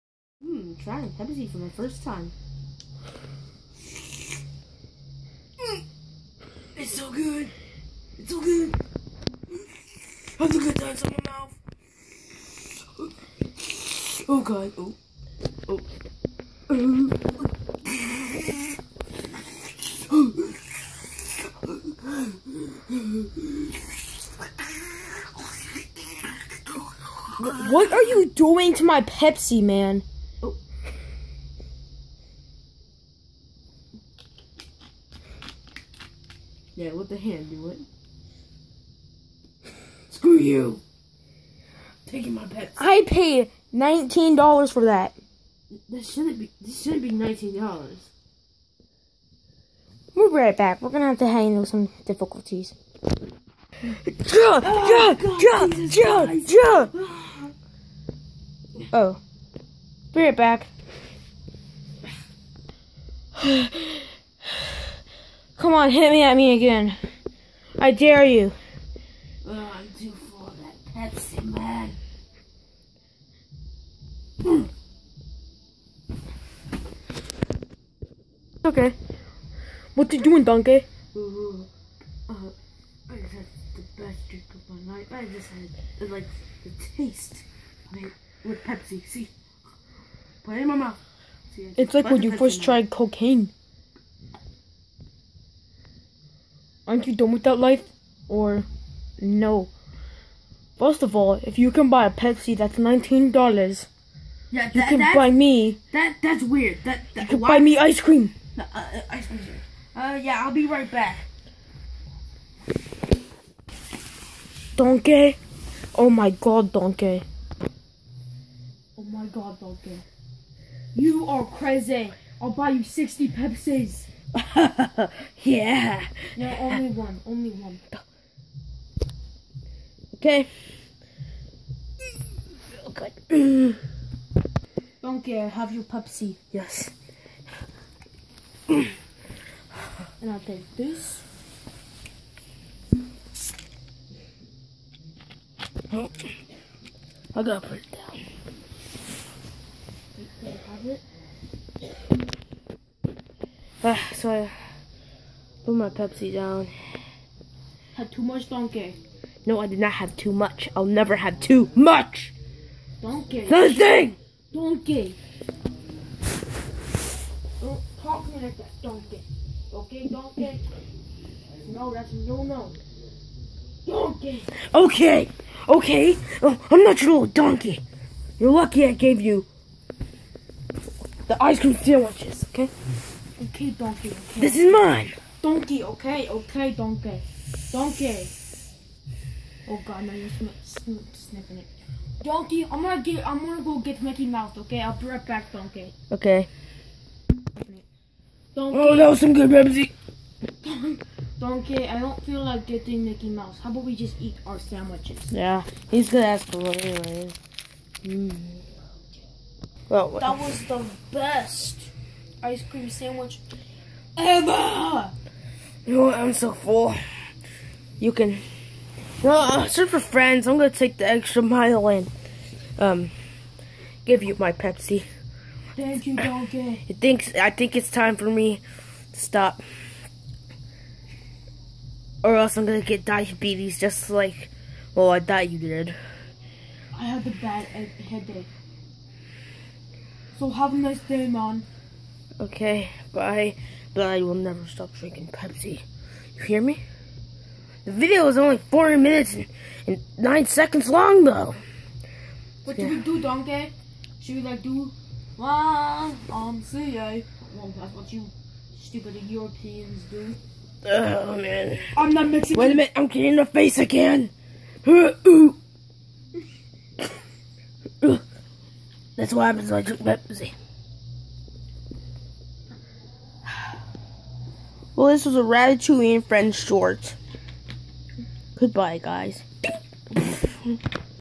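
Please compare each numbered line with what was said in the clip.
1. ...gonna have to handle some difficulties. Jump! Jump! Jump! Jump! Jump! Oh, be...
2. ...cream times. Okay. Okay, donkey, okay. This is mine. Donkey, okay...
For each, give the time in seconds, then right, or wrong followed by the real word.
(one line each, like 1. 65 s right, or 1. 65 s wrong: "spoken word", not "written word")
1. 50 s right
2. 181 s wrong: "sandwiches", not "times".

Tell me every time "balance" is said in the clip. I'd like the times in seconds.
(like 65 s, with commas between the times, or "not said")
not said.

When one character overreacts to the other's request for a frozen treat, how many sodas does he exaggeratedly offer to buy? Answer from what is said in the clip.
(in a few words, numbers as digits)
60.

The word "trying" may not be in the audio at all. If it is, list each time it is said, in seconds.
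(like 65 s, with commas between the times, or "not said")
0 s.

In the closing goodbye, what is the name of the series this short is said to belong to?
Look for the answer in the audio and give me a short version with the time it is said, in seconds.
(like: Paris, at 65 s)
Ratatouille and Friends, at 275 s.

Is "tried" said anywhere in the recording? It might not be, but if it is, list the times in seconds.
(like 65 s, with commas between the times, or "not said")
92 s.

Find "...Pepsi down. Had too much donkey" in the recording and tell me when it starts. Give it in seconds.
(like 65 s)
155 s.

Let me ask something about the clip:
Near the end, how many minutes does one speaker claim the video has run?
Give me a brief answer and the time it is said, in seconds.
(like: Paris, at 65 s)
40 minutes, at 248 s.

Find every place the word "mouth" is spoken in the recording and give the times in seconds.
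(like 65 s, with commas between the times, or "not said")
11 s, 90 s.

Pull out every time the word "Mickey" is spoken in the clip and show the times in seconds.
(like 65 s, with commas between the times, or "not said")
194 s, 203 s.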